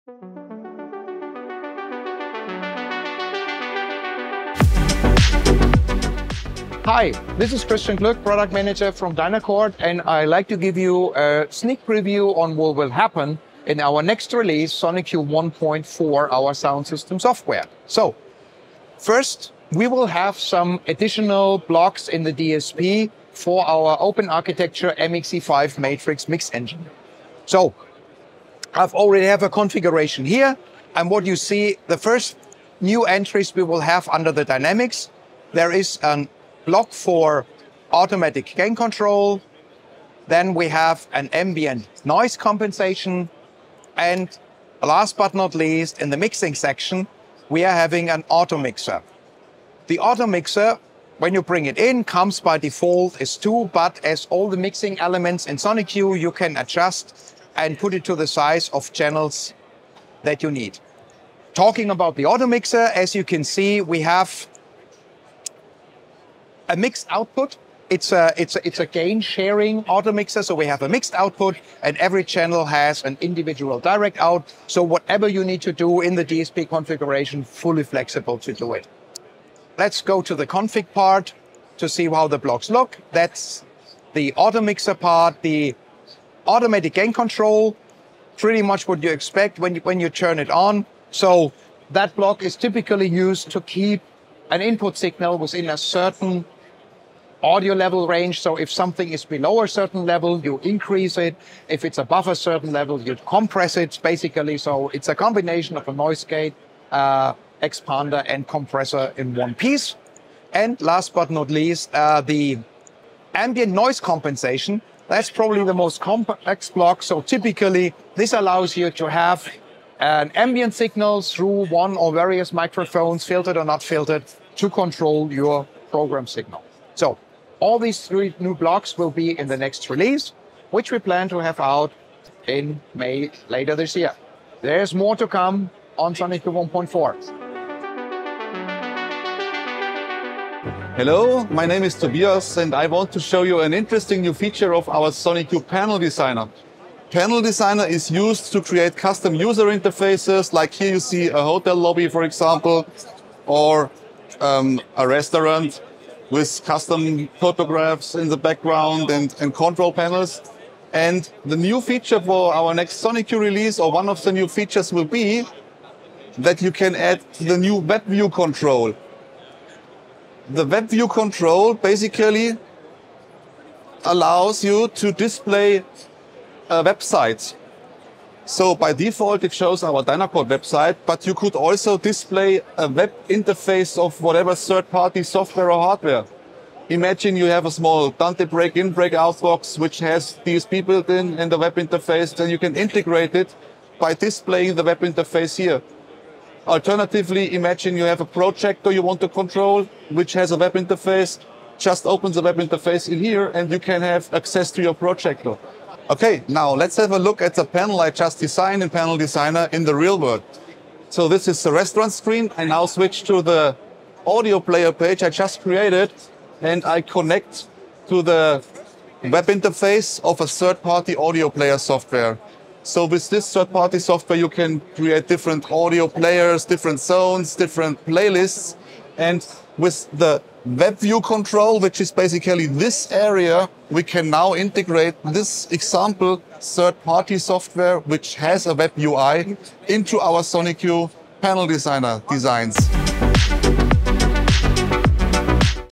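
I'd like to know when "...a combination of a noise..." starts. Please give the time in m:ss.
1:45.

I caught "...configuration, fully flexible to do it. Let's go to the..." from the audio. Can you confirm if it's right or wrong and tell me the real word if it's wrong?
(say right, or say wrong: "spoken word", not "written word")
right.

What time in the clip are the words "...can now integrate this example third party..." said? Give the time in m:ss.
3:54.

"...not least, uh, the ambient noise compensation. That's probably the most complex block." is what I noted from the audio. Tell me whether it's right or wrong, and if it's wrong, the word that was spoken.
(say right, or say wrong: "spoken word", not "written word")
right.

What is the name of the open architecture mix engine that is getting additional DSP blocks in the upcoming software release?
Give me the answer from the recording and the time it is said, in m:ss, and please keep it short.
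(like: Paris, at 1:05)
MXE5, at 0:24.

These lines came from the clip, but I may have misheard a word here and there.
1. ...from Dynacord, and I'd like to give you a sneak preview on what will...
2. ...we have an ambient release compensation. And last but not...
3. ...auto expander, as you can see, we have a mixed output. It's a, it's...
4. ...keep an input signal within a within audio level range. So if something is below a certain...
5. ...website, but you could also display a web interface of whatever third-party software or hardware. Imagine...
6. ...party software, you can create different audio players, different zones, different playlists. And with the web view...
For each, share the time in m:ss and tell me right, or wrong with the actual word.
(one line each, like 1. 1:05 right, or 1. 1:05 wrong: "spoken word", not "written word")
1. 0:08 right
2. 0:40 wrong: "noise", not "release"
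3. 1:02 wrong: "mixer", not "expander"
4. 1:33 wrong: "certain", not "within"
5. 3:00 right
6. 3:43 right.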